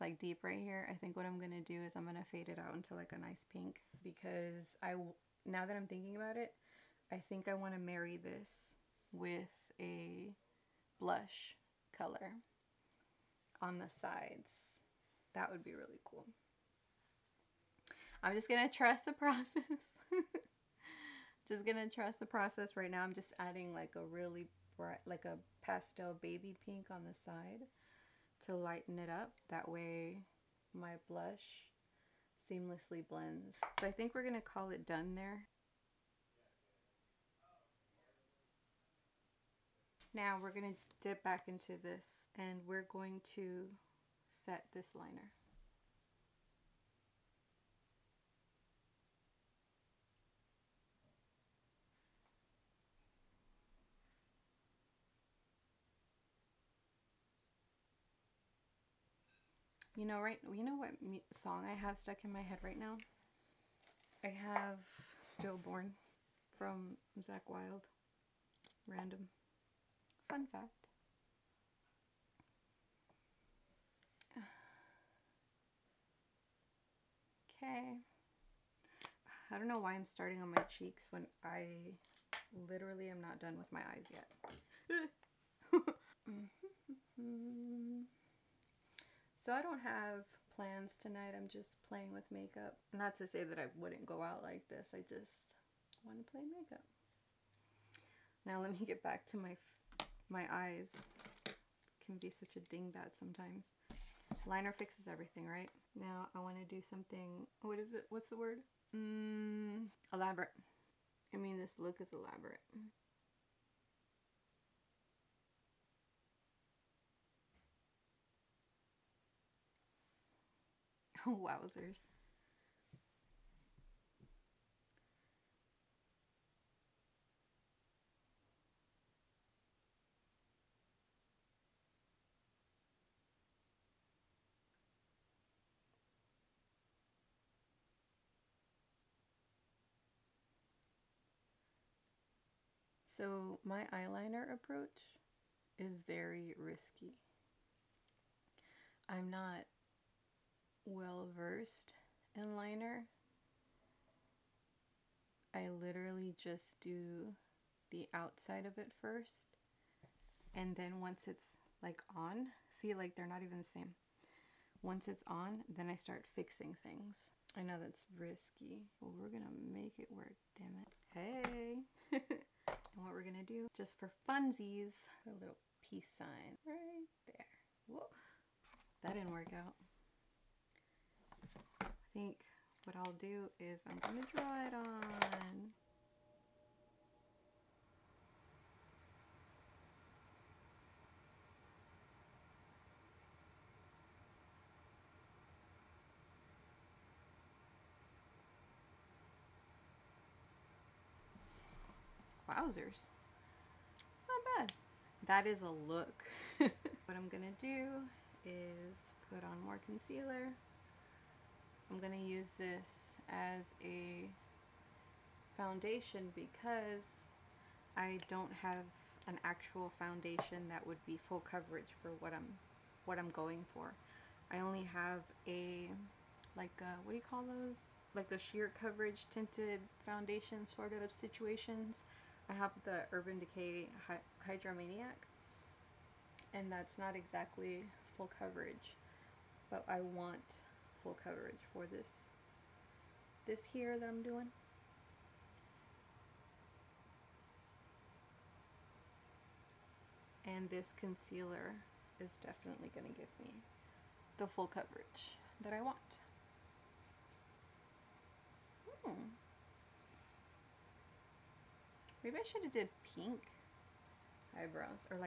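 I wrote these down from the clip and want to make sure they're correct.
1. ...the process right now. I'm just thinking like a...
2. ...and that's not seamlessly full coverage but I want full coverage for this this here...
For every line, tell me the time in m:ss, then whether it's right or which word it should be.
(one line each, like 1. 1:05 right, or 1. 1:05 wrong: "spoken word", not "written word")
1. 0:22 wrong: "adding", not "thinking"
2. 3:56 wrong: "exactly", not "seamlessly".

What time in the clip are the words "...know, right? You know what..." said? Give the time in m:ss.
1:00.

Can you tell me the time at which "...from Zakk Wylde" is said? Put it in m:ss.
1:06.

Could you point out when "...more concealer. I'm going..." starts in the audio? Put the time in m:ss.
3:29.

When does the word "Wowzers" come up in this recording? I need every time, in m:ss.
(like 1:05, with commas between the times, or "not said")
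2:01, 3:22.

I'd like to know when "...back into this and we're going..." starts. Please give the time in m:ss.
0:41.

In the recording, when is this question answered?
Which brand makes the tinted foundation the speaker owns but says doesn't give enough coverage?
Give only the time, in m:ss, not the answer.
3:53.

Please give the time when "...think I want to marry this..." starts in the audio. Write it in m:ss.
0:07.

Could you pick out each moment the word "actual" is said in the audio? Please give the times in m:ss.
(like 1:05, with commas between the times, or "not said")
3:39.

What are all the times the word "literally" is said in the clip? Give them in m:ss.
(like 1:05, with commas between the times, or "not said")
1:22, 2:35.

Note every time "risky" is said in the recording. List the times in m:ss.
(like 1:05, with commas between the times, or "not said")
2:26, 2:48.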